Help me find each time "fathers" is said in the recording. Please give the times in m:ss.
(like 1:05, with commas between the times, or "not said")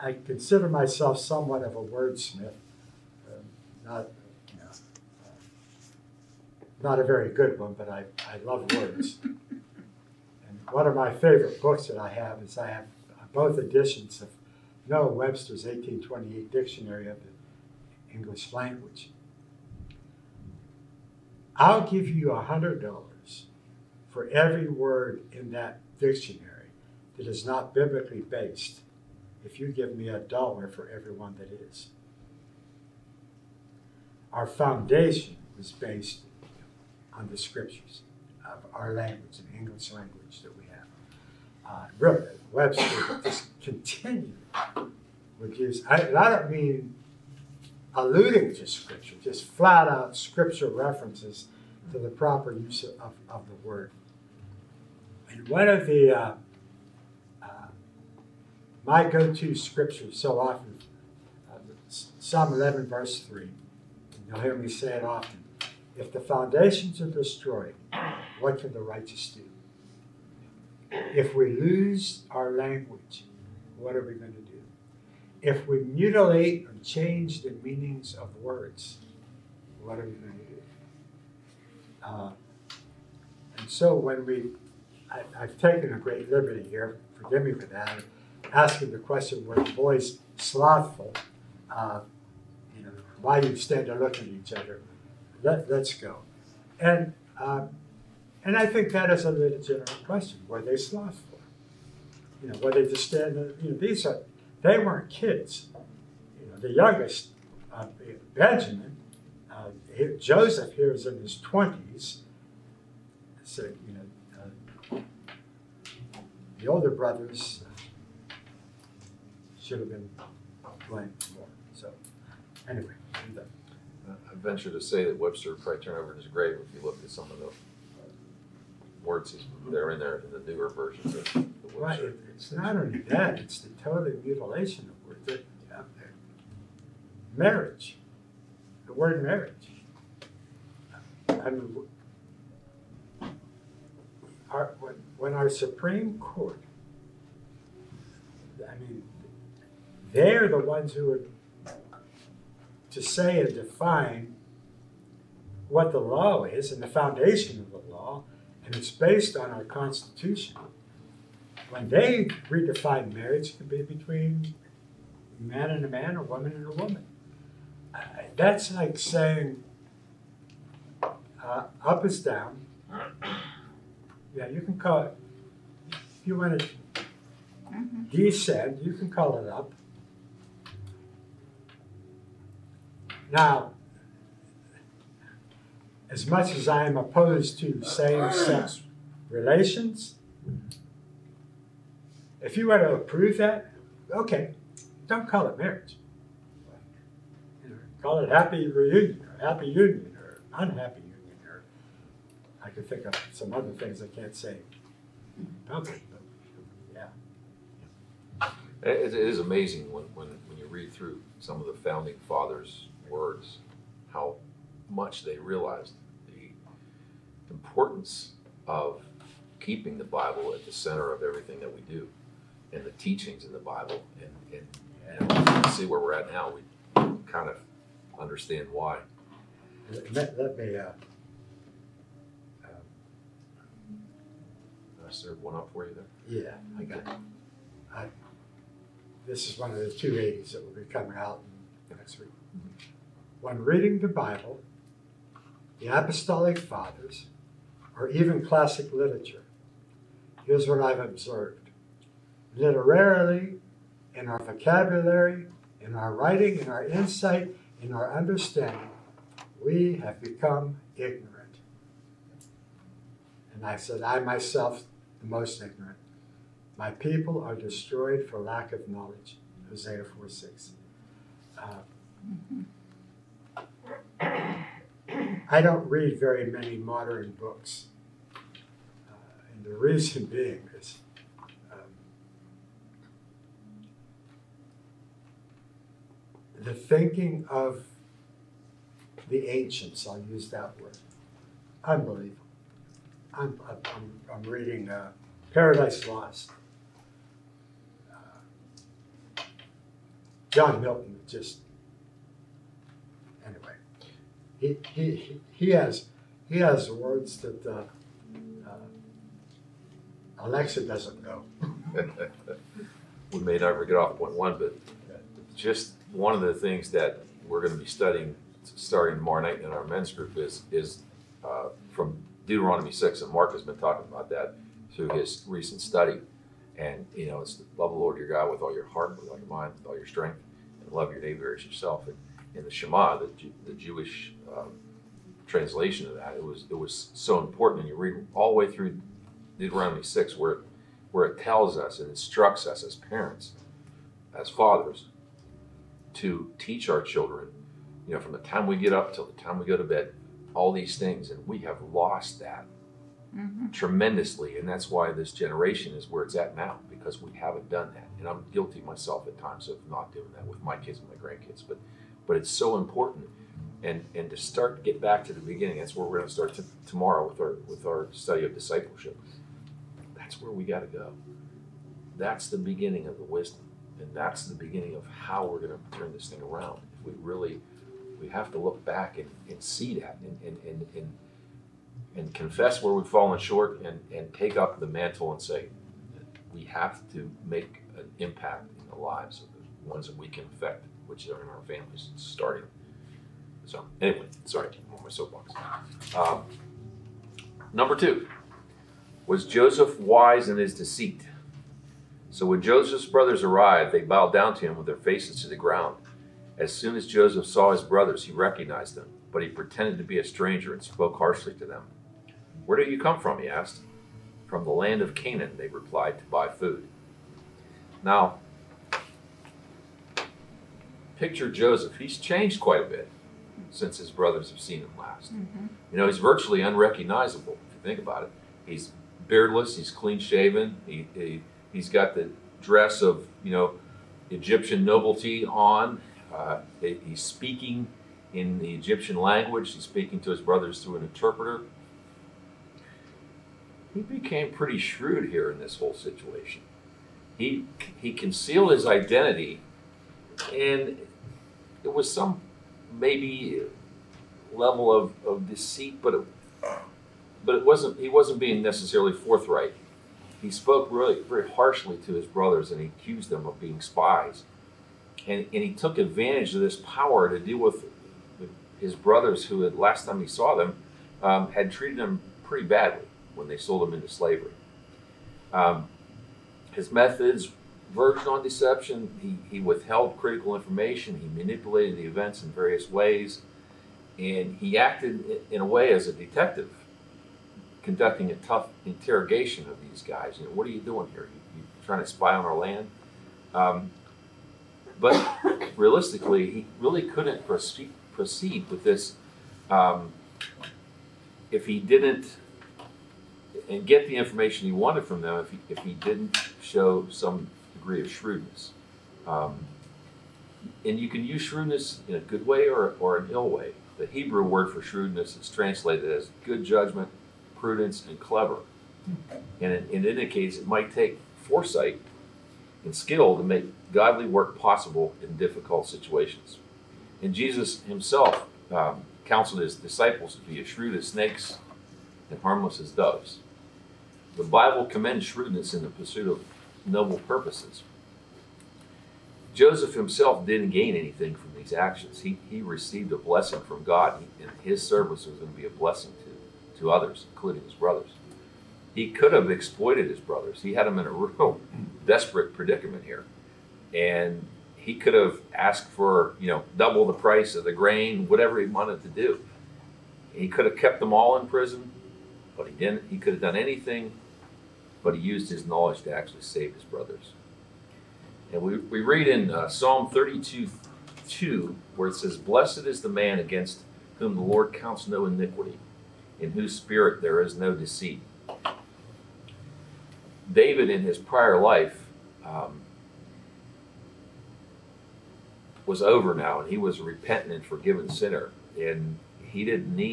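3:32, 4:06, 5:44.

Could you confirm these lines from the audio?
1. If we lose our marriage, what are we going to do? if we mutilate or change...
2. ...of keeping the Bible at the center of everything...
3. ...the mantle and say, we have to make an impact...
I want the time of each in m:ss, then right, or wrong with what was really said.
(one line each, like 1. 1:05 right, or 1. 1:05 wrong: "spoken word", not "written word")
1. 1:11 wrong: "language", not "marriage"
2. 3:38 right
3. 6:24 right.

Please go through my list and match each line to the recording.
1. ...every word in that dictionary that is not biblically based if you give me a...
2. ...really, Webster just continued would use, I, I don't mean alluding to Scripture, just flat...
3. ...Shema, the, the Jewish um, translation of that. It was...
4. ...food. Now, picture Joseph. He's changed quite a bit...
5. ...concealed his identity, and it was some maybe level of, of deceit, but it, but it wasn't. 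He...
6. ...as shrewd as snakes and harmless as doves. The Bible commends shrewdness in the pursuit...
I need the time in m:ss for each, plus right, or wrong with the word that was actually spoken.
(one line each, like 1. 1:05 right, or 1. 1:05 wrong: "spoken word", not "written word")
1. 0:24 right
2. 0:41 right
3. 5:32 right
4. 6:56 right
5. 7:28 right
6. 8:50 right.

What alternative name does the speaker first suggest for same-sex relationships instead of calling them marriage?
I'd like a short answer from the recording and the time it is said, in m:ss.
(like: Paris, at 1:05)
happy reunion, at 3:18.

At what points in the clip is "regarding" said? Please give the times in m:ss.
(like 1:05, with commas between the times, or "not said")
not said.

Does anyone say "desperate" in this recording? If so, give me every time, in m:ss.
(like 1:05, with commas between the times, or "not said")
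9:12.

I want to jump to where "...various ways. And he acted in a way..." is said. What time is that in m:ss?
8:02.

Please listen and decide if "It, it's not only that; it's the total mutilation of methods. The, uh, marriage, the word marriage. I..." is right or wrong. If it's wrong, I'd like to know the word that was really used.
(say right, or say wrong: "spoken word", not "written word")
wrong: "words", not "methods".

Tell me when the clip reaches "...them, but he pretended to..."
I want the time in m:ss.
6:48.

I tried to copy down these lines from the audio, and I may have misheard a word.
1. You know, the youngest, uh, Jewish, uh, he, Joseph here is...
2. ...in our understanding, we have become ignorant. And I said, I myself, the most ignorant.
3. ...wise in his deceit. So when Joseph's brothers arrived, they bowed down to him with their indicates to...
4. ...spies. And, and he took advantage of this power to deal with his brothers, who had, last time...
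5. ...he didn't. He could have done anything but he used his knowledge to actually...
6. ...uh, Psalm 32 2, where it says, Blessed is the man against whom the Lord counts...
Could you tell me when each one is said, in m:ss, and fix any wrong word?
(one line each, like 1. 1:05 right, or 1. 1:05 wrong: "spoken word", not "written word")
1. 1:46 wrong: "Benjamin", not "Jewish"
2. 4:17 right
3. 6:39 wrong: "faces", not "indicates"
4. 7:43 right
5. 9:22 right
6. 9:29 right.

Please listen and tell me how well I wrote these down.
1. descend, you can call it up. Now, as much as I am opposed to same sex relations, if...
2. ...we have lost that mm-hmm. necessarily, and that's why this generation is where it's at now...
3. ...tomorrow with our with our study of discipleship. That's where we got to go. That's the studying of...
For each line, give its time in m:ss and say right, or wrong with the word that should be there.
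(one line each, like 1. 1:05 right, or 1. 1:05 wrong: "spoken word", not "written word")
1. 2:58 right
2. 5:51 wrong: "tremendously", not "necessarily"
3. 6:06 wrong: "beginning", not "studying".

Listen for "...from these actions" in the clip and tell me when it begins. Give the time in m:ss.
9:01.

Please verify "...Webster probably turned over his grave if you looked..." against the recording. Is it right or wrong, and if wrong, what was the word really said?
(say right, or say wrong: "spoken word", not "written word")
right.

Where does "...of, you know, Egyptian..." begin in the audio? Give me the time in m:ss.
7:13.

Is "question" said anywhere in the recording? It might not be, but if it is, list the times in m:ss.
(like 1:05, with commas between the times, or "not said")
1:28, 1:40.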